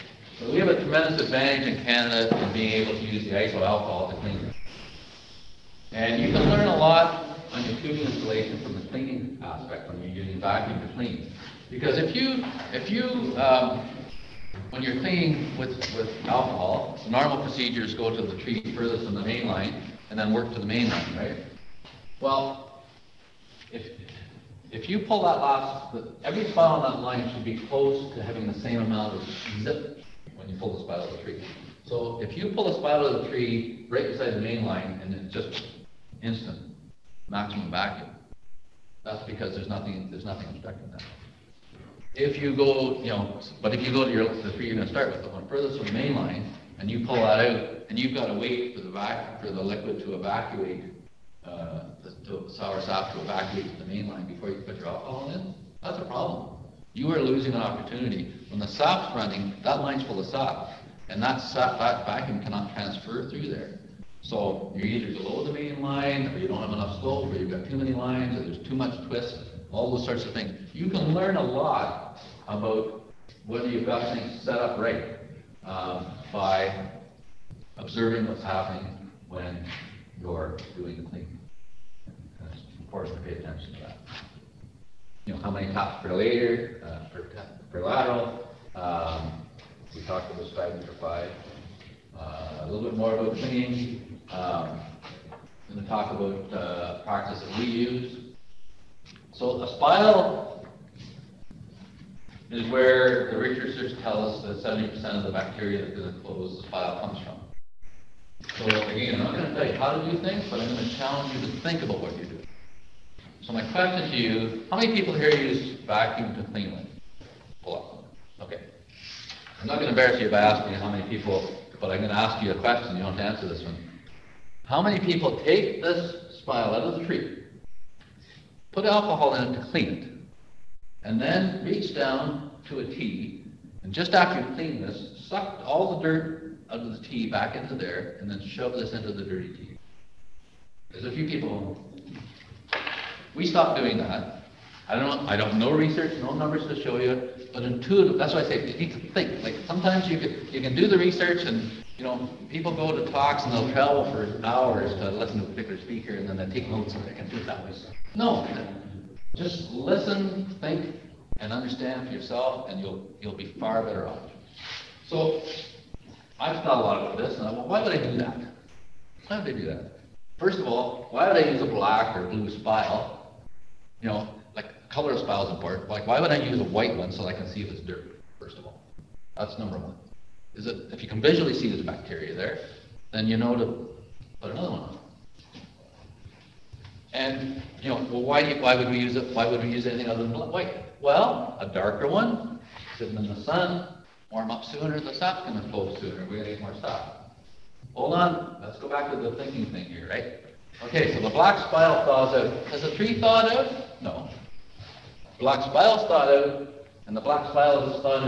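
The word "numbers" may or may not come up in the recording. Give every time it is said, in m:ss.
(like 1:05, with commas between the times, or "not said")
2:26, 2:59.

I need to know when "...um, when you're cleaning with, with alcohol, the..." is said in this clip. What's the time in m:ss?
0:13.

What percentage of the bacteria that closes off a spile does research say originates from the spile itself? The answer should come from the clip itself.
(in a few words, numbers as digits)
70%.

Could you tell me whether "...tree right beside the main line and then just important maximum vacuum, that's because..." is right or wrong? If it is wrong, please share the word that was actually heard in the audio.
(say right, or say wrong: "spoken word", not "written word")
wrong: "instant", not "important".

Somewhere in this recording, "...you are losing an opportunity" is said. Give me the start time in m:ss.
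0:56.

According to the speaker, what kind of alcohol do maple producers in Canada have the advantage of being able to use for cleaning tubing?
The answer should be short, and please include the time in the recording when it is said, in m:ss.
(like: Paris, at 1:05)
ISO alcohol, at 0:03.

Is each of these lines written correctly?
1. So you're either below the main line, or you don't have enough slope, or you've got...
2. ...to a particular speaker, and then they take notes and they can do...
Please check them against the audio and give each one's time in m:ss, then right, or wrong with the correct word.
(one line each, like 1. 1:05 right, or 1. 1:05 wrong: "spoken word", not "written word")
1. 1:04 right
2. 2:35 right.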